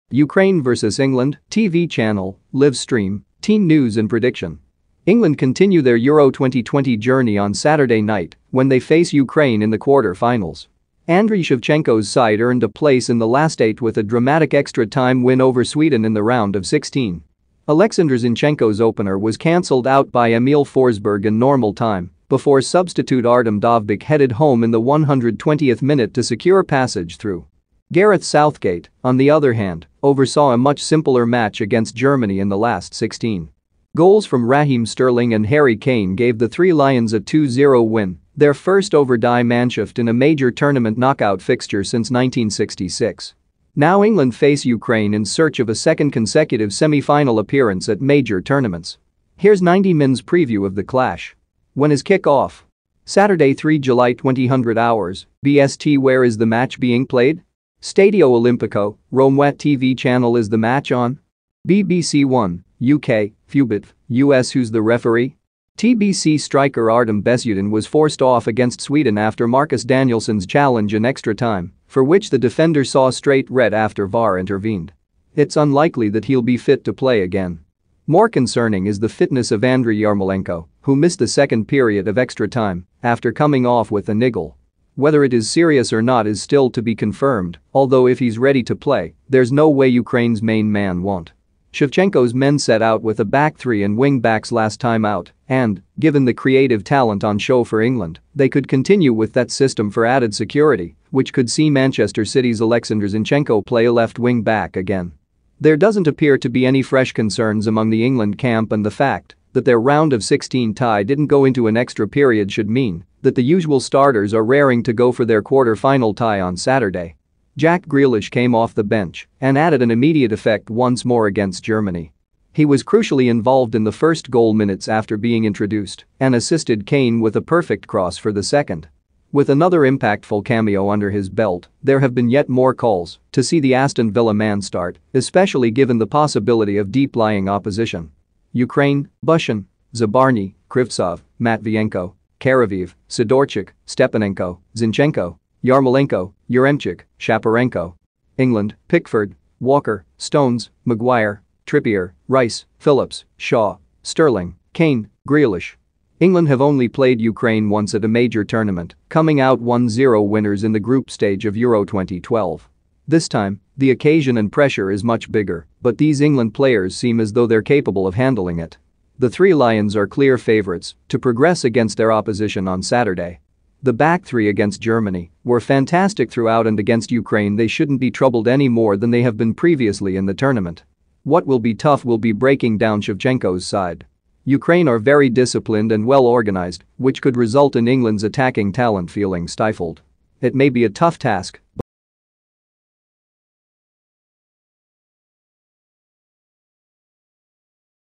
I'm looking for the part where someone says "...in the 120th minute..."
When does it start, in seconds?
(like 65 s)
24 s.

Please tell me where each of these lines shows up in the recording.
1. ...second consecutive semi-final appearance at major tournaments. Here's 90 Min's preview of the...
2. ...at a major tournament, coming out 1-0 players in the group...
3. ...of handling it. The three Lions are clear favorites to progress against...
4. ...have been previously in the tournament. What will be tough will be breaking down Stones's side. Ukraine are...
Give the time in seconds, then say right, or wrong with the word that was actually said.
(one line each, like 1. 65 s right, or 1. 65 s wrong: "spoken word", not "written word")
1. 45 s right
2. 157 s wrong: "winners", not "players"
3. 168 s right
4. 179 s wrong: "Shevchenko", not "Stones".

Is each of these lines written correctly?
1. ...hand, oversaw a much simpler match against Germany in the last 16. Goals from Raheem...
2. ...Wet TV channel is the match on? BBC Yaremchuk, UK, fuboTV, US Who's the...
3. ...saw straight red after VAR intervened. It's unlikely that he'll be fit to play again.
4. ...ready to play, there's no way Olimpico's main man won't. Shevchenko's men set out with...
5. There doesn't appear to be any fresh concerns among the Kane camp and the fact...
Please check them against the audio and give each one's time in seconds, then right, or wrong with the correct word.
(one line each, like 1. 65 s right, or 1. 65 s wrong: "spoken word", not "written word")
1. 29 s right
2. 59 s wrong: "One", not "Yaremchuk"
3. 72 s right
4. 88 s wrong: "Ukraine", not "Olimpico"
5. 105 s wrong: "England", not "Kane".